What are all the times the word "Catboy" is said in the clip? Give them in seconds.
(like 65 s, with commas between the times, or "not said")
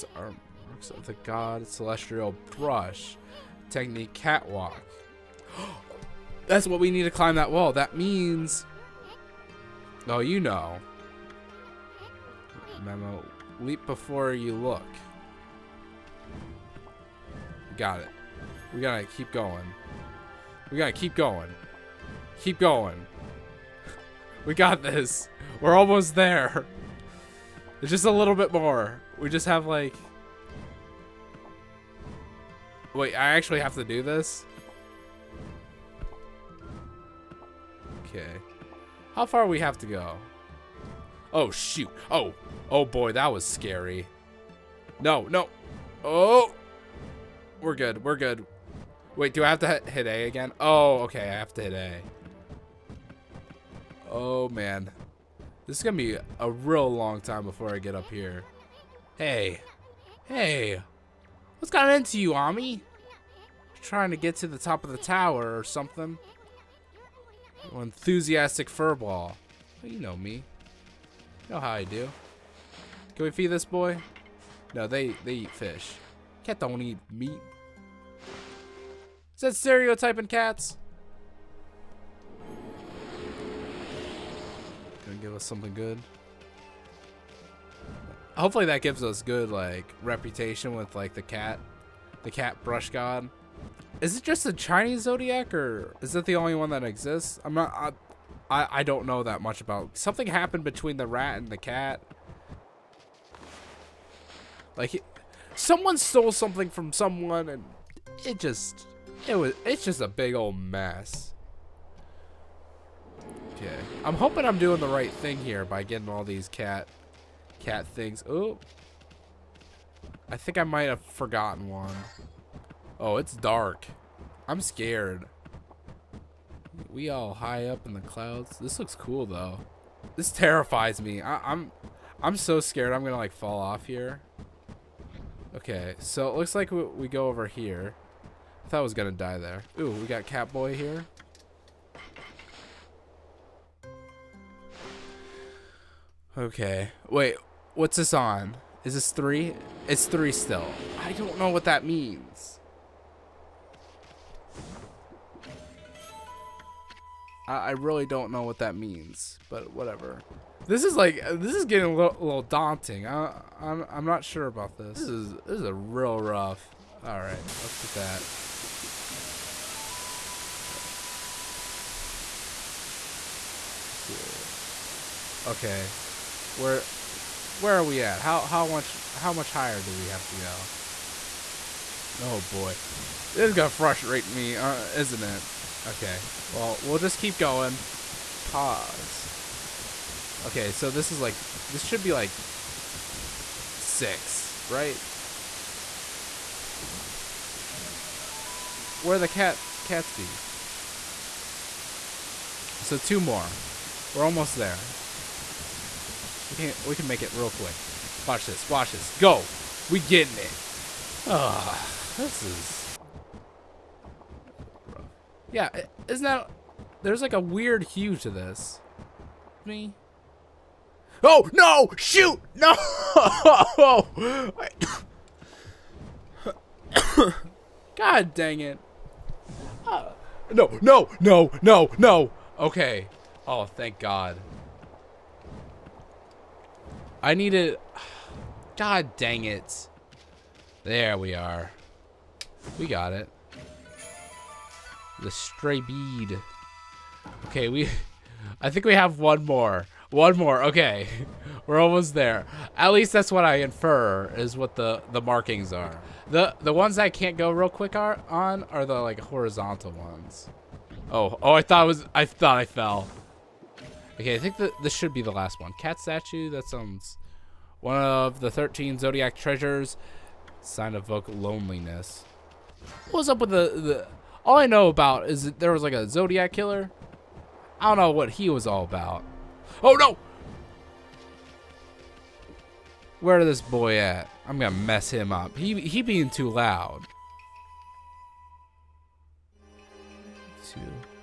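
140 s.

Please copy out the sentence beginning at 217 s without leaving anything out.
There's like a weird hue to this.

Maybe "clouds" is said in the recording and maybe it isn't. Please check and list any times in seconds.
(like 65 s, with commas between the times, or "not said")
128 s.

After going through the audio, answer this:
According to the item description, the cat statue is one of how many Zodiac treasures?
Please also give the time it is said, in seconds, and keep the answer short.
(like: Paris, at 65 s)
13, at 268 s.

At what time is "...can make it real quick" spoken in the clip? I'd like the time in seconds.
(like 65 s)
206 s.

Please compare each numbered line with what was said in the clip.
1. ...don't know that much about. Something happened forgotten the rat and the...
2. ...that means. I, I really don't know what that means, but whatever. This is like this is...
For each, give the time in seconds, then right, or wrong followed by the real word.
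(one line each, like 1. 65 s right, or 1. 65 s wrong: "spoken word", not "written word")
1. 98 s wrong: "between", not "forgotten"
2. 151 s right.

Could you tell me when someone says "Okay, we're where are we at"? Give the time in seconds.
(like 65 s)
175 s.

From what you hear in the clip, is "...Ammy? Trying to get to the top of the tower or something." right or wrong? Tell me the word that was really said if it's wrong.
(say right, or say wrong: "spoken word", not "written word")
right.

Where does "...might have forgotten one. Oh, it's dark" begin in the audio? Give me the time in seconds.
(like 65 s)
120 s.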